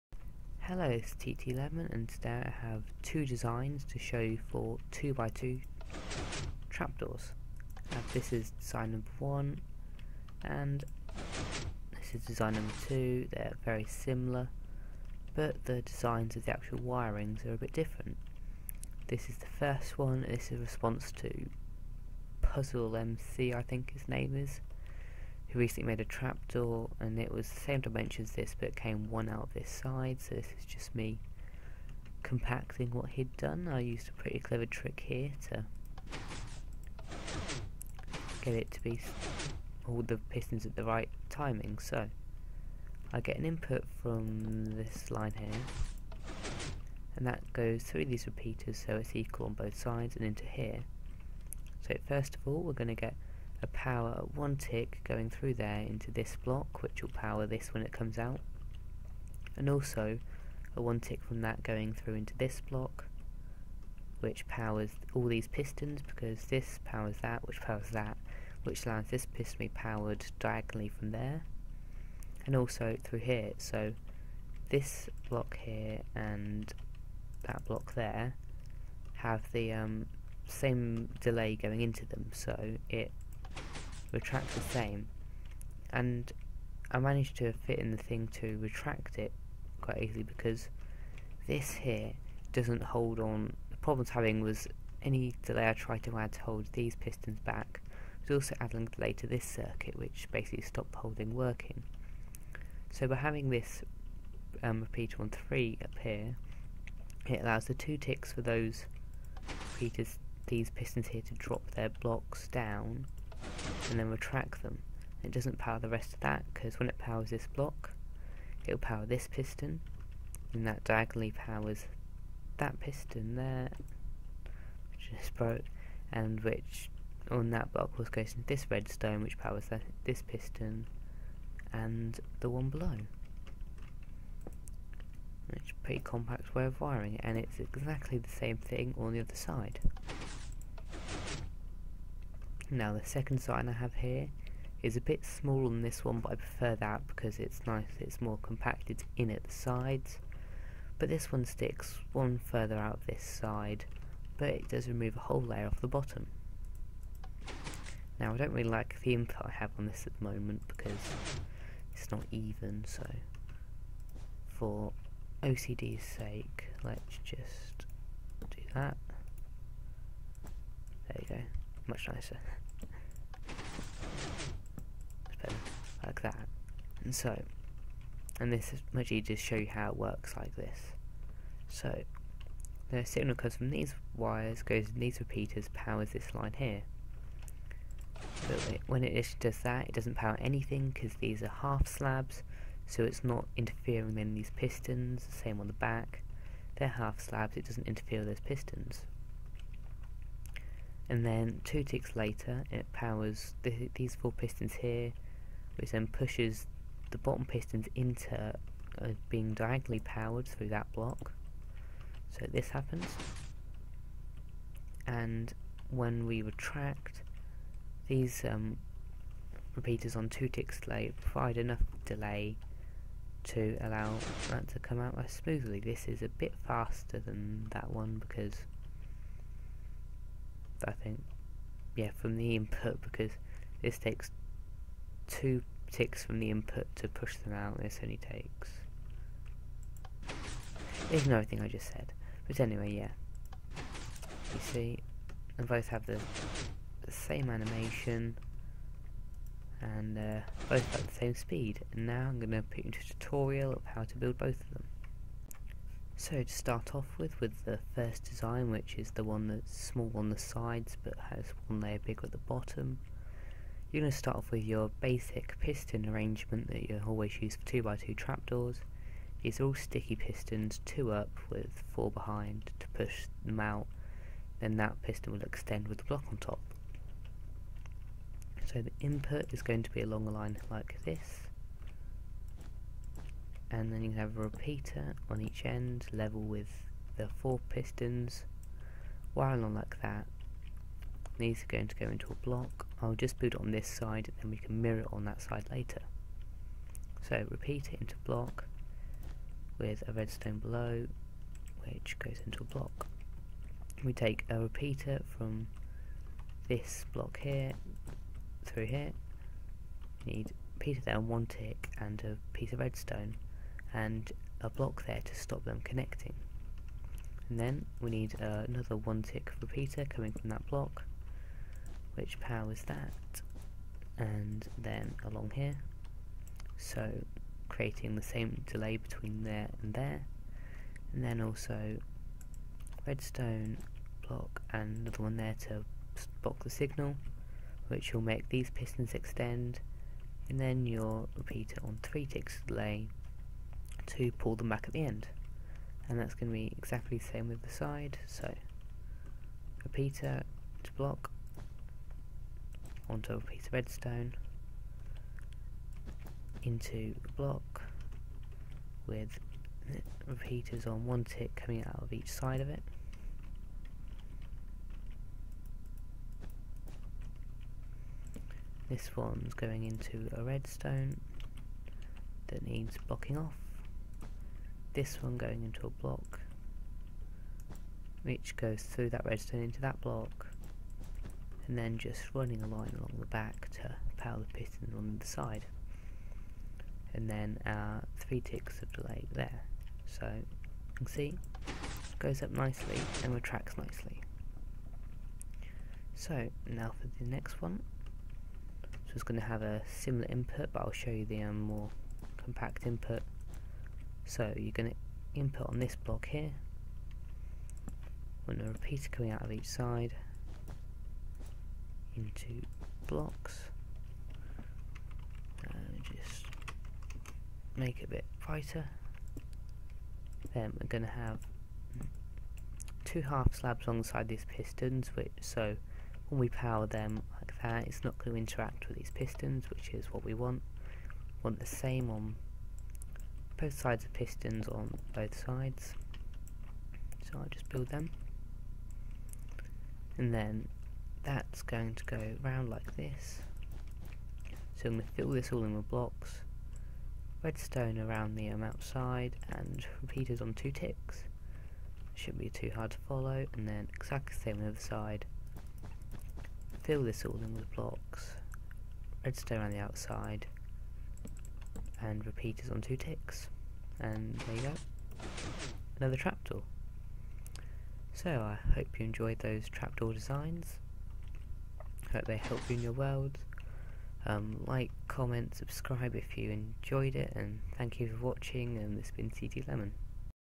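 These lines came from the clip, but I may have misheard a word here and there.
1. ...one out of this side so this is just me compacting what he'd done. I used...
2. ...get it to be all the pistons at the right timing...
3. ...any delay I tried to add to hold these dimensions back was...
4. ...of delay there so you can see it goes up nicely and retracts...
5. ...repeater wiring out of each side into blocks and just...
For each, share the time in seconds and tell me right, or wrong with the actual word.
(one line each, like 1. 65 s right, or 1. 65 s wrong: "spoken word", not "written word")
1. 29 s right
2. 38 s right
3. 95 s wrong: "pistons", not "dimensions"
4. 388 s right
5. 408 s wrong: "coming", not "wiring".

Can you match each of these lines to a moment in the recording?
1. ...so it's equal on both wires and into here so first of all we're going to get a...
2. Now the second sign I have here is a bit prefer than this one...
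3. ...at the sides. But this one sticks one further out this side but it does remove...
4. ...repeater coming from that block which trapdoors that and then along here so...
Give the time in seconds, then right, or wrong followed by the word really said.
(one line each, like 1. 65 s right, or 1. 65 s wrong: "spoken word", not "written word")
1. 48 s wrong: "sides", not "wires"
2. 142 s wrong: "smaller", not "prefer"
3. 149 s right
4. 319 s wrong: "powers", not "trapdoors".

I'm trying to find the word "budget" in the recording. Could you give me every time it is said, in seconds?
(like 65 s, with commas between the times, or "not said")
not said.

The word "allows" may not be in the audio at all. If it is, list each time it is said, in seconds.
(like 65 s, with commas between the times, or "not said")
68 s, 107 s, 223 s.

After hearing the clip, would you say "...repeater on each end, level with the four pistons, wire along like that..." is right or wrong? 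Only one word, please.
right.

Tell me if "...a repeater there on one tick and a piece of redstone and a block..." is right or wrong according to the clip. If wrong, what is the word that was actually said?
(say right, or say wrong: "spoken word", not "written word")
right.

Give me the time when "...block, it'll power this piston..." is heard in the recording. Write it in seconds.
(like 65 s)
117 s.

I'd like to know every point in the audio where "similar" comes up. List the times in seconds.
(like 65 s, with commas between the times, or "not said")
13 s, 399 s.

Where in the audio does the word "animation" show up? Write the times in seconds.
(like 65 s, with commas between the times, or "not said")
247 s.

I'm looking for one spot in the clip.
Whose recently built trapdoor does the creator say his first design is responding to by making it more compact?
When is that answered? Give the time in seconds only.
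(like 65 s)
22 s.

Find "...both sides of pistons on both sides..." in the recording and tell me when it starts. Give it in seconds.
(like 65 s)
433 s.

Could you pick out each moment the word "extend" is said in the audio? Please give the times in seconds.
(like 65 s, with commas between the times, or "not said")
275 s, 339 s.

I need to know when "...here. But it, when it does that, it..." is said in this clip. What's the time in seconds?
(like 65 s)
186 s.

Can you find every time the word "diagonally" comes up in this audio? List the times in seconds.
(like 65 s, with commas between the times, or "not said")
70 s, 120 s, 209 s.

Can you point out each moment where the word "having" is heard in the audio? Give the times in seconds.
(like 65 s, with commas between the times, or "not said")
94 s, 103 s.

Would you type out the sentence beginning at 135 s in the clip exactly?
It's a pretty compact way of wiring, and it's exactly the same thing on the other side.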